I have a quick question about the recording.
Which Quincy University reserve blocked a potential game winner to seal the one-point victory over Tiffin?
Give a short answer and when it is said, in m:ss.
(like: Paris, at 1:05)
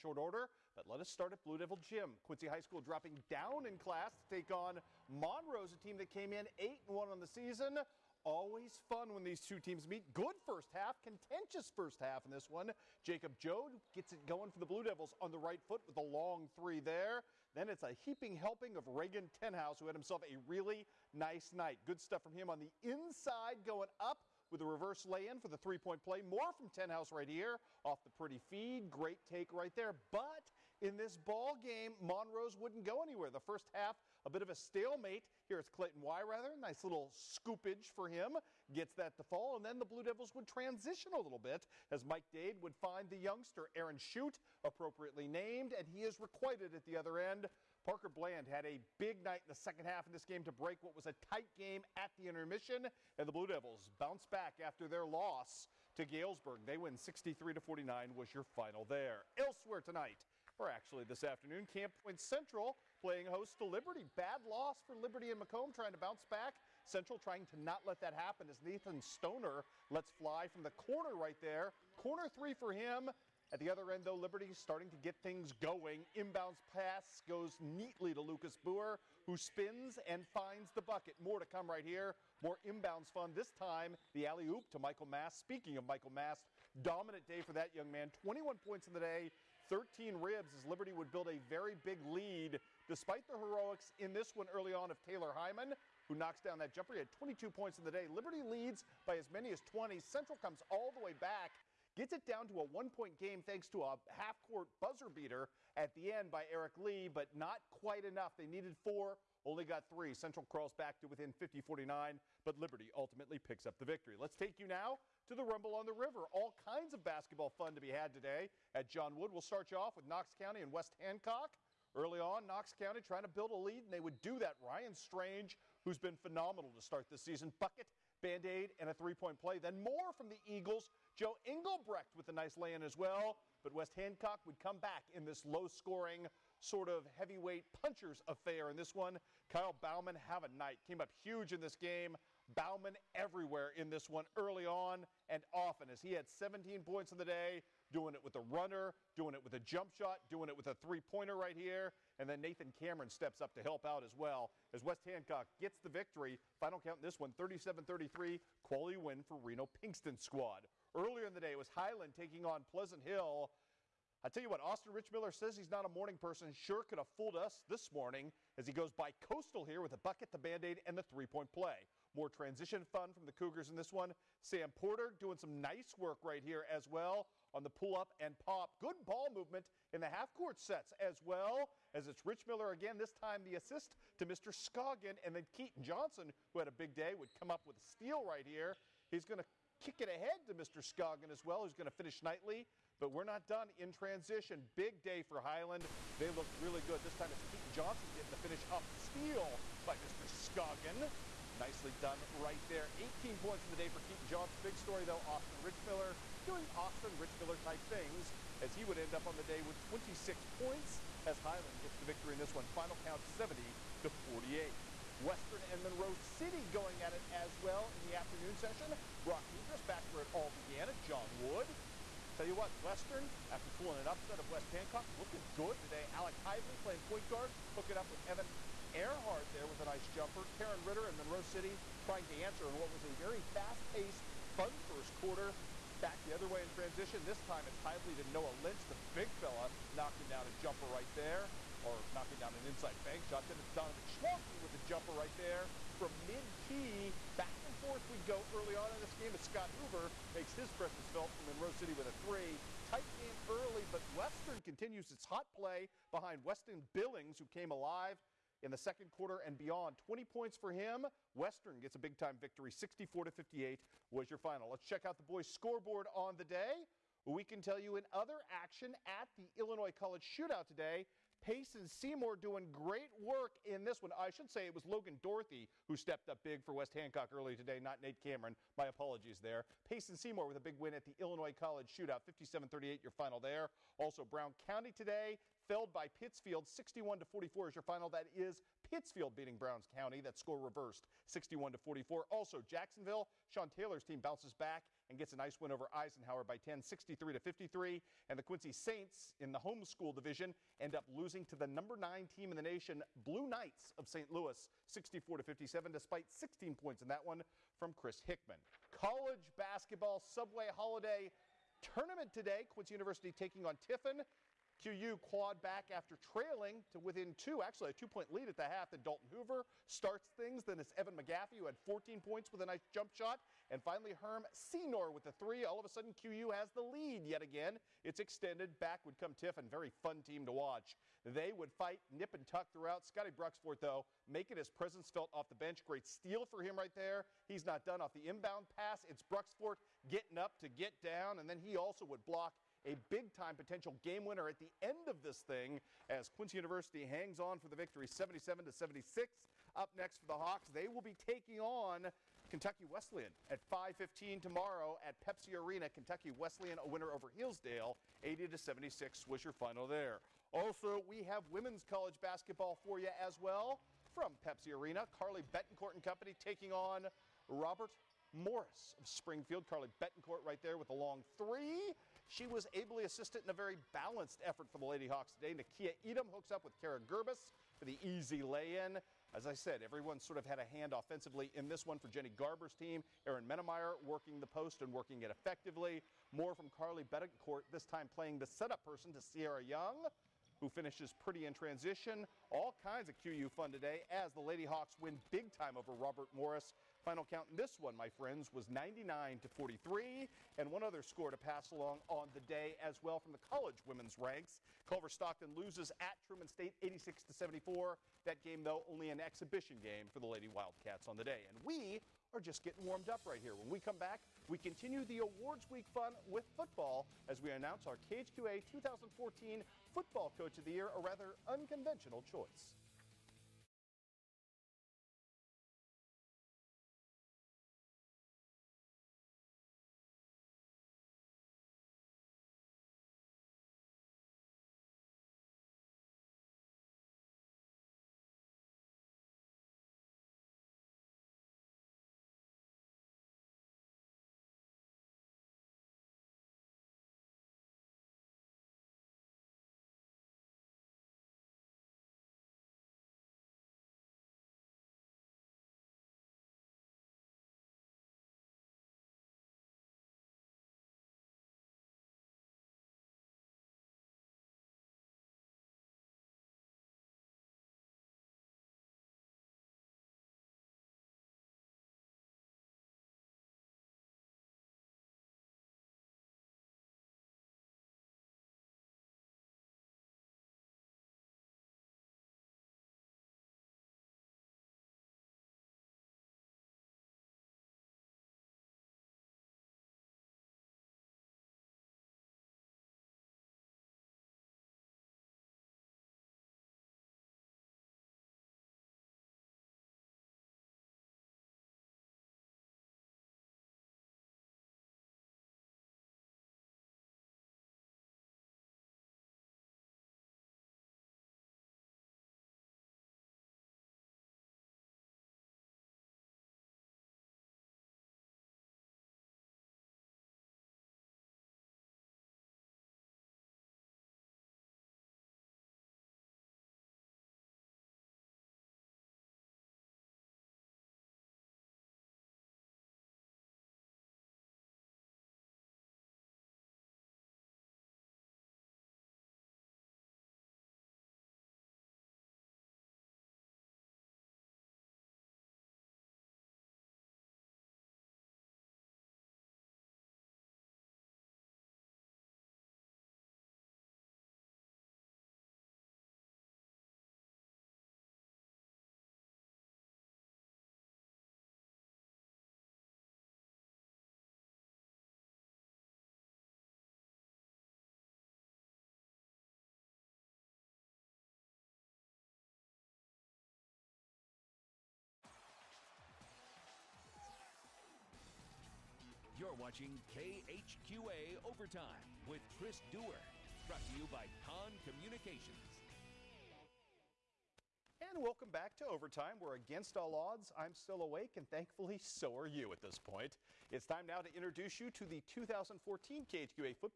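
Scotty Bruxford, at 5:33.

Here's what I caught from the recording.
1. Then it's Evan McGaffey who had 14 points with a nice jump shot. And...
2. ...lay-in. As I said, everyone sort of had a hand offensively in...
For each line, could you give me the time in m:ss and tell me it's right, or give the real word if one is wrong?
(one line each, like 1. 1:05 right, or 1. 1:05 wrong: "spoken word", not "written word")
1. 5:20 right
2. 6:18 right.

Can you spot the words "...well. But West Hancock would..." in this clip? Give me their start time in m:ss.
2:12.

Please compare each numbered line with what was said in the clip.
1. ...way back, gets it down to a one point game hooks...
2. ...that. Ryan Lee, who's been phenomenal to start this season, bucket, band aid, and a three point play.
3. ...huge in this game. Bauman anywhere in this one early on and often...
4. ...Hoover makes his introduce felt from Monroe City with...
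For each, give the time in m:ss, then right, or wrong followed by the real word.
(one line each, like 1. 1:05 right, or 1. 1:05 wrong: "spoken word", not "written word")
1. 1:41 wrong: "thanks", not "hooks"
2. 2:04 wrong: "Strange", not "Lee"
3. 2:21 wrong: "everywhere", not "anywhere"
4. 4:09 wrong: "presence", not "introduce".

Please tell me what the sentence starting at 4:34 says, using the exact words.
I should say it was Logan Dorothy who stepped up big for West Hancock early today, not Nate Cameron.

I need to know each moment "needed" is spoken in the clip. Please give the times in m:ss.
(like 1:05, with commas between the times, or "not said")
1:48.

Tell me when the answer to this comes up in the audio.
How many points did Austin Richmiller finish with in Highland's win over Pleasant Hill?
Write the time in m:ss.
3:29.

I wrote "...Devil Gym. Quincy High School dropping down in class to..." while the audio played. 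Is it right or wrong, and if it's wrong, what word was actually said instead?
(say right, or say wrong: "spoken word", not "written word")
right.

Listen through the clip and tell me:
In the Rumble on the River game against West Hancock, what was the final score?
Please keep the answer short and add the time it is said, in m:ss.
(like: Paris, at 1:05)
37-33, at 2:37.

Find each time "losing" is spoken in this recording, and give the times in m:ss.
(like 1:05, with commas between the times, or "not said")
5:01.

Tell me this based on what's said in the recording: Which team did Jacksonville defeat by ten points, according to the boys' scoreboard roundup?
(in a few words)
Eisenhower.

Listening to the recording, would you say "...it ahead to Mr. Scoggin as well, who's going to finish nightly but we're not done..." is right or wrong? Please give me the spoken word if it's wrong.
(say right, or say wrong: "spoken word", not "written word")
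right.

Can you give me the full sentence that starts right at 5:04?
Louis, 64 to 57, despite 16 points in that one from Chris Hickman.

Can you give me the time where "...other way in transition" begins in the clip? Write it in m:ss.
3:56.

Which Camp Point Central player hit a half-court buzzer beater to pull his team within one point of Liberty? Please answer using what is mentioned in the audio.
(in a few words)
Eric Lee.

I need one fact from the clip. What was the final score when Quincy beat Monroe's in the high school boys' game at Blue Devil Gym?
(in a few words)
63 to 49.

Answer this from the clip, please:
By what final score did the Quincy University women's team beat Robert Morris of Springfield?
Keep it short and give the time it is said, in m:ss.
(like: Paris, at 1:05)
99 to 43, at 6:38.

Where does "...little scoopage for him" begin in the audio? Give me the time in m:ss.
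0:36.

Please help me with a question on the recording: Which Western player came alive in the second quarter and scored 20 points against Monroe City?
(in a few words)
Weston Billings.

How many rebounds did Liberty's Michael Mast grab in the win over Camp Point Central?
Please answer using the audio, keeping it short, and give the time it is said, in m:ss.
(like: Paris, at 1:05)
13, at 1:29.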